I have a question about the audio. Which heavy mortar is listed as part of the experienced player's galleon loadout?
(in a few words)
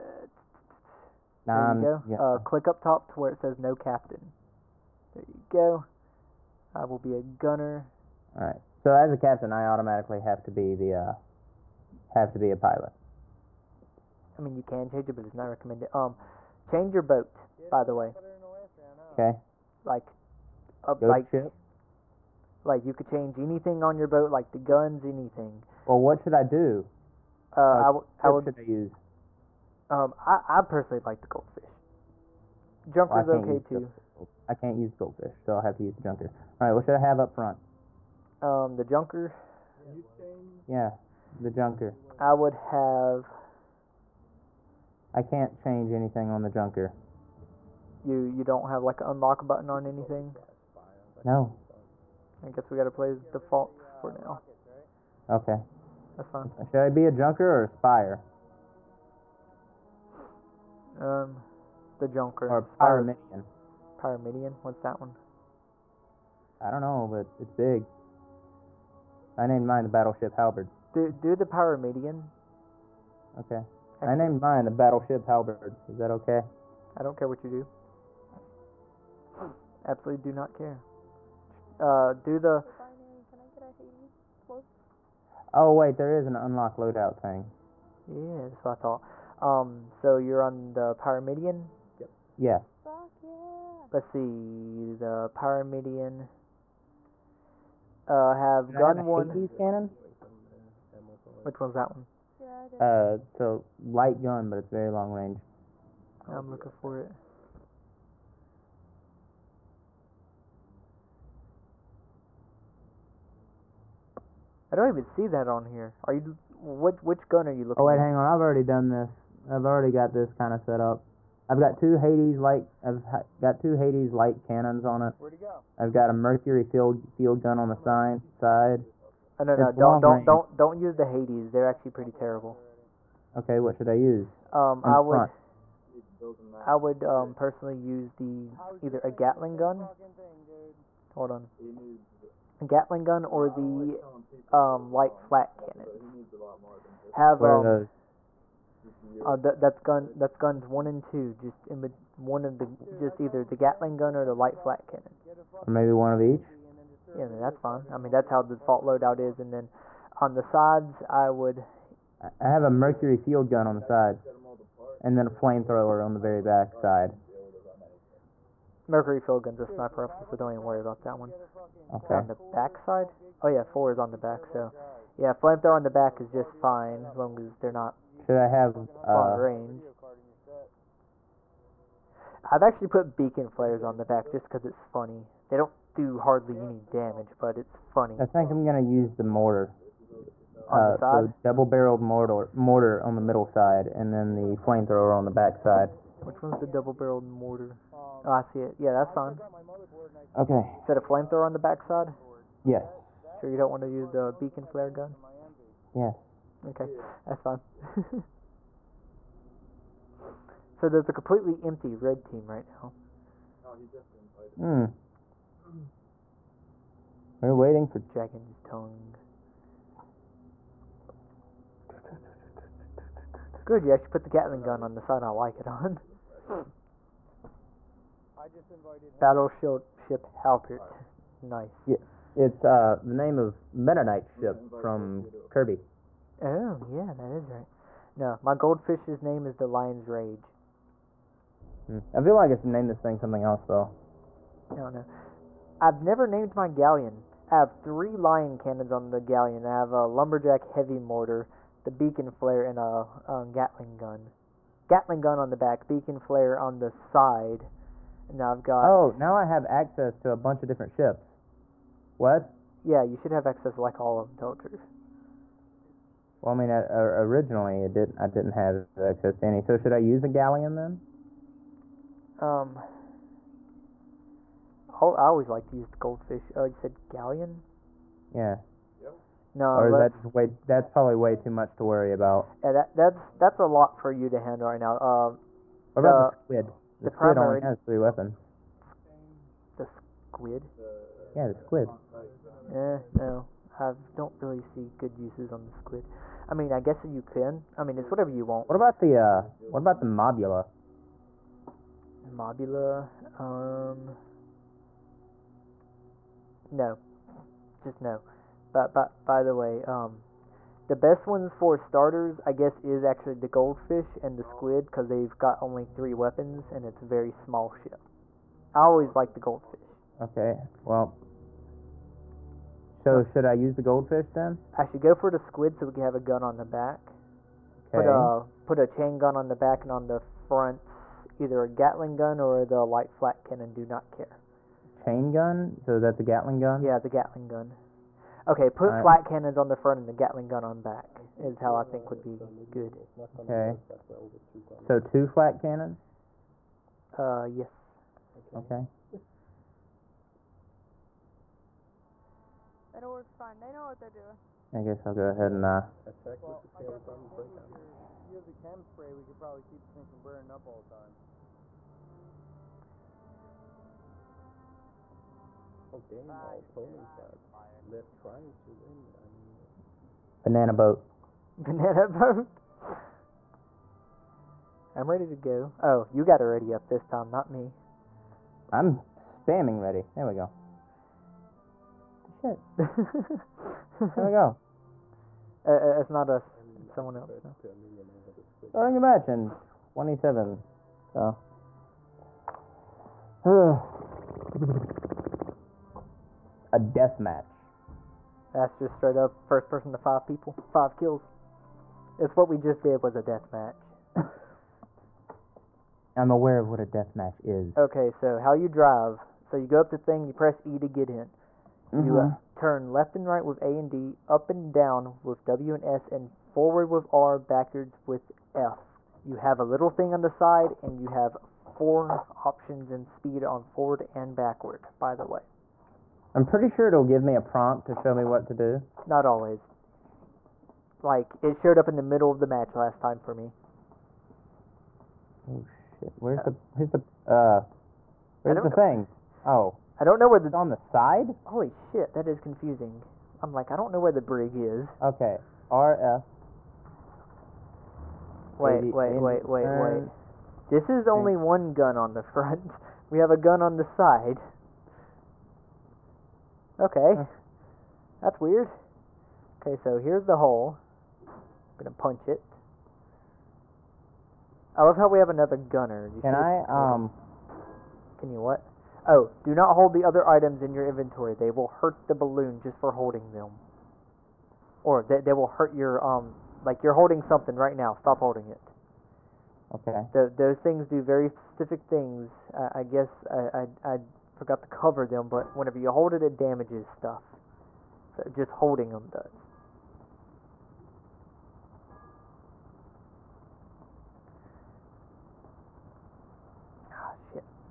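Lumberjack heavy mortar.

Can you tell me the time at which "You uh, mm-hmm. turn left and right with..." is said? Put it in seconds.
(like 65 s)
412 s.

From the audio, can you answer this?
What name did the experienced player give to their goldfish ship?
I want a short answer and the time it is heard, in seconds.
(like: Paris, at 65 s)
Lion's Rage, at 239 s.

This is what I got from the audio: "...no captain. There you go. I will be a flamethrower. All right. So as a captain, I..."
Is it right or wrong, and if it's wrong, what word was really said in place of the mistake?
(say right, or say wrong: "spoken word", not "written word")
wrong: "gunner", not "flamethrower".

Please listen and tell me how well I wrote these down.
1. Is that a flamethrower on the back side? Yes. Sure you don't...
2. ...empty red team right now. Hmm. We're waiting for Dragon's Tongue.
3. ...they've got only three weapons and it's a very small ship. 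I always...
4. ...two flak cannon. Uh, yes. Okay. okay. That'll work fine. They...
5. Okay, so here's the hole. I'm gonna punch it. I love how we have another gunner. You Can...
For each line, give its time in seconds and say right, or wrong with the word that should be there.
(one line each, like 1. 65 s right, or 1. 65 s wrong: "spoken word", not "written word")
1. 200 s right
2. 211 s right
3. 315 s right
4. 344 s right
5. 459 s right.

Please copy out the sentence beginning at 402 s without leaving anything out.
It's what we just did was a death match.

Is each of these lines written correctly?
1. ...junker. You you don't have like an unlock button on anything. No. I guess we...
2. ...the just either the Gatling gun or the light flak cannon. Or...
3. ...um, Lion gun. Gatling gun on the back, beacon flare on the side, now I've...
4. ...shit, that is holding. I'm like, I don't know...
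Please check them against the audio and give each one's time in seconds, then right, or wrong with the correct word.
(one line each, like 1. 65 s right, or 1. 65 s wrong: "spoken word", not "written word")
1. 46 s right
2. 152 s right
3. 253 s wrong: "Gatling", not "Lion"
4. 441 s wrong: "confusing", not "holding".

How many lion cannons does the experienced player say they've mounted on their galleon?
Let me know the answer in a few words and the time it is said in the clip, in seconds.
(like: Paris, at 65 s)
3, at 247 s.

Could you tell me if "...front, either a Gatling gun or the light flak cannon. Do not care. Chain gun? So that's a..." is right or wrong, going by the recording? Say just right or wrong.
right.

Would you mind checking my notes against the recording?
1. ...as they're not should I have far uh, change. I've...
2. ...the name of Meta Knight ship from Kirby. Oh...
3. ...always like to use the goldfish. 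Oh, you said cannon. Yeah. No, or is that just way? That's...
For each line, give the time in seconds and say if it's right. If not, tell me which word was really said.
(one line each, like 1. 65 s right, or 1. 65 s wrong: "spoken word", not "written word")
1. 177 s wrong: "range", not "change"
2. 233 s right
3. 275 s wrong: "galleon", not "cannon".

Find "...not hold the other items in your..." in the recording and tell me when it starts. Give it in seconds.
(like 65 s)
469 s.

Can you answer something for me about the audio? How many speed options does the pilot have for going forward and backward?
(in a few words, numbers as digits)
4.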